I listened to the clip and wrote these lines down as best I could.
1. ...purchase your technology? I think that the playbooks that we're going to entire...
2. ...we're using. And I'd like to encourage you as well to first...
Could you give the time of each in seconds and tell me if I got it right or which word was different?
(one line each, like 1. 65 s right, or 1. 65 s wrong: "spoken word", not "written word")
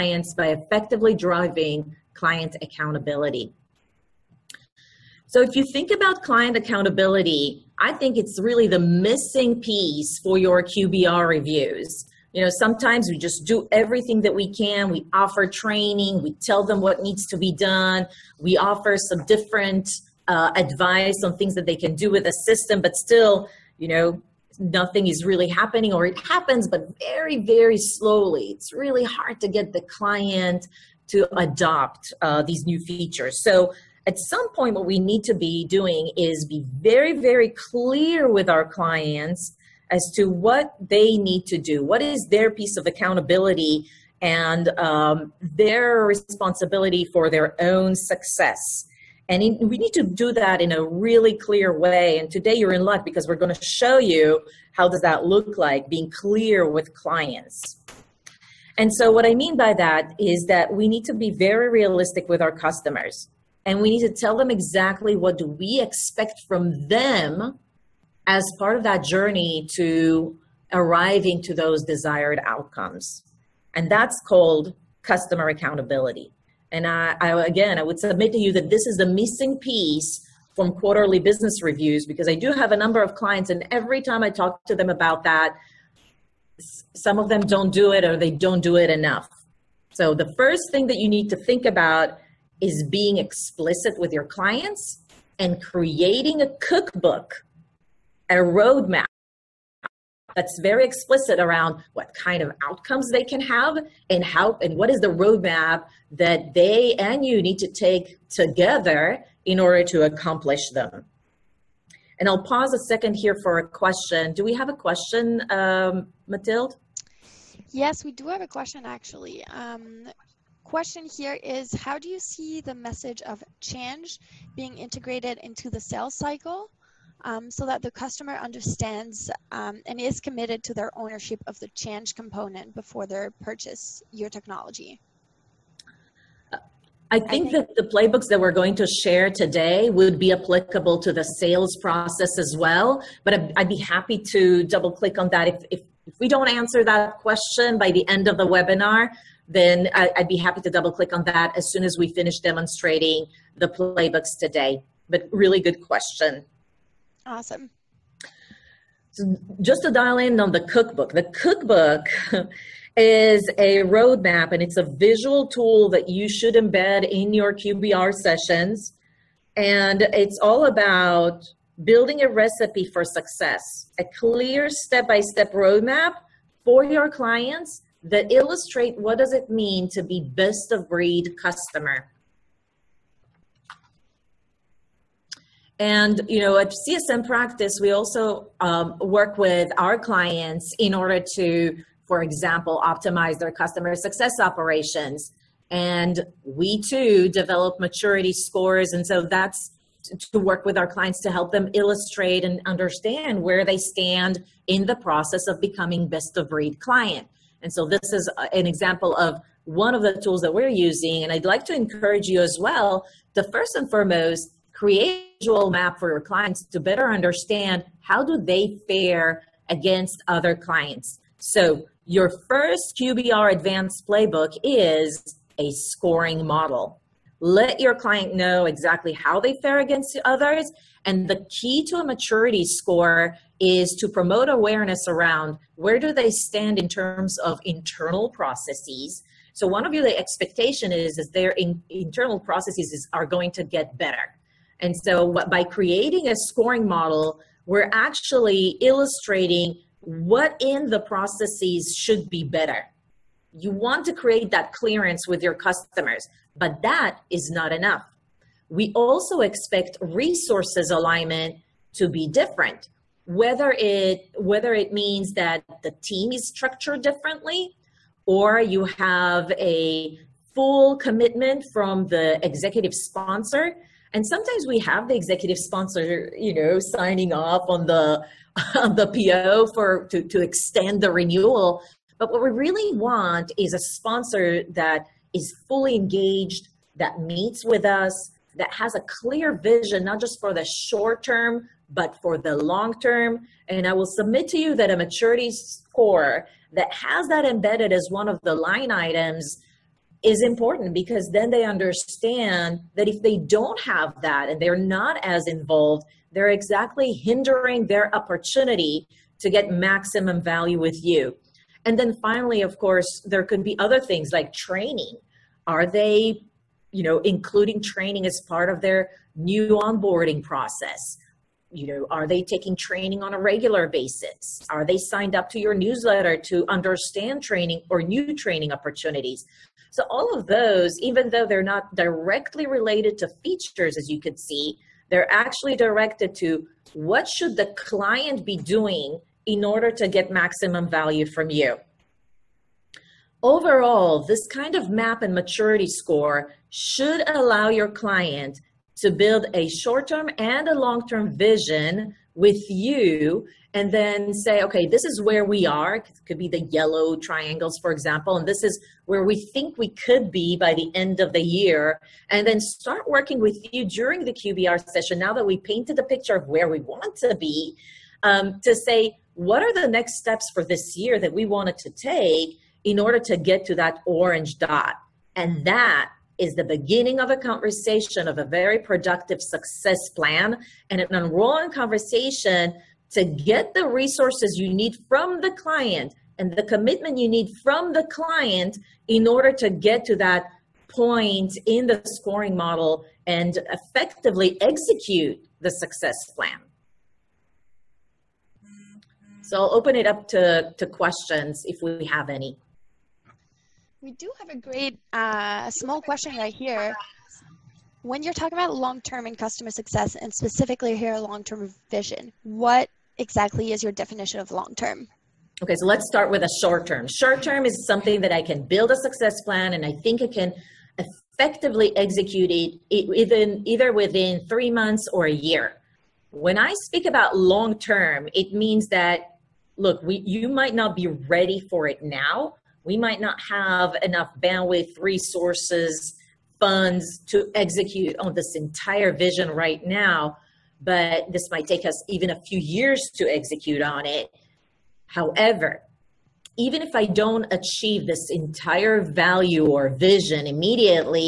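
1. 133 s wrong: "share", not "entire"
2. 210 s right.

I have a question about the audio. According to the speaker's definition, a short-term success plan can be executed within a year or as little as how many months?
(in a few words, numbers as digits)
3 months.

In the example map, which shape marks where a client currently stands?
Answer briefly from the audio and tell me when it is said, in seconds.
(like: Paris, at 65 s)
Yellow triangles, at 356 s.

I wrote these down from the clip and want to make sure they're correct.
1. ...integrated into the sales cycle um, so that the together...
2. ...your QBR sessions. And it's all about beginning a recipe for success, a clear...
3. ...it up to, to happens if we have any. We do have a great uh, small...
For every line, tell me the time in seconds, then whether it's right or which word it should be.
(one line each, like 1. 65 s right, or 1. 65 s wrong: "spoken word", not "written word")
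1. 124 s wrong: "customer", not "together"
2. 167 s wrong: "building", not "beginning"
3. 399 s wrong: "questions", not "happens".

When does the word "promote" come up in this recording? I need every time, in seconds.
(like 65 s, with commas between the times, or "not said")
234 s.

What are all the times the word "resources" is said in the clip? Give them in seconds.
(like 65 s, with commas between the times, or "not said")
260 s, 383 s, 434 s.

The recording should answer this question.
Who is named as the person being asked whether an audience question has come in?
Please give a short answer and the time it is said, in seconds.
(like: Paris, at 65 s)
Mathilde, at 116 s.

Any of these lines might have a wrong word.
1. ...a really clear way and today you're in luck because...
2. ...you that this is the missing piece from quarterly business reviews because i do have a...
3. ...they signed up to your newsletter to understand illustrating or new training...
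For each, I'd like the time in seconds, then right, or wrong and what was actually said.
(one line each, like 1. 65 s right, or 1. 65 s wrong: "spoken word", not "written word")
1. 50 s right
2. 78 s right
3. 324 s wrong: "training", not "illustrating".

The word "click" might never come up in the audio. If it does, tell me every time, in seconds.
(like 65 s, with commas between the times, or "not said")
144 s, 150 s.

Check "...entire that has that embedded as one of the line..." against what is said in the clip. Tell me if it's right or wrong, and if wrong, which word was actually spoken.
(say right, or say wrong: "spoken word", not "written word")
wrong: "score", not "entire".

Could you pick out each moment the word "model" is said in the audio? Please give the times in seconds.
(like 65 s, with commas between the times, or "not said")
226 s, 246 s, 392 s.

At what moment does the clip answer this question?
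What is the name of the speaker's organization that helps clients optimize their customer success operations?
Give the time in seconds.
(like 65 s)
186 s.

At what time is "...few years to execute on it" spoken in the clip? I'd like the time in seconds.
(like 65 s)
442 s.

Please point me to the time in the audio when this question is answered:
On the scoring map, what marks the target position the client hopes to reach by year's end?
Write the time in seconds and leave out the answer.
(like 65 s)
374 s.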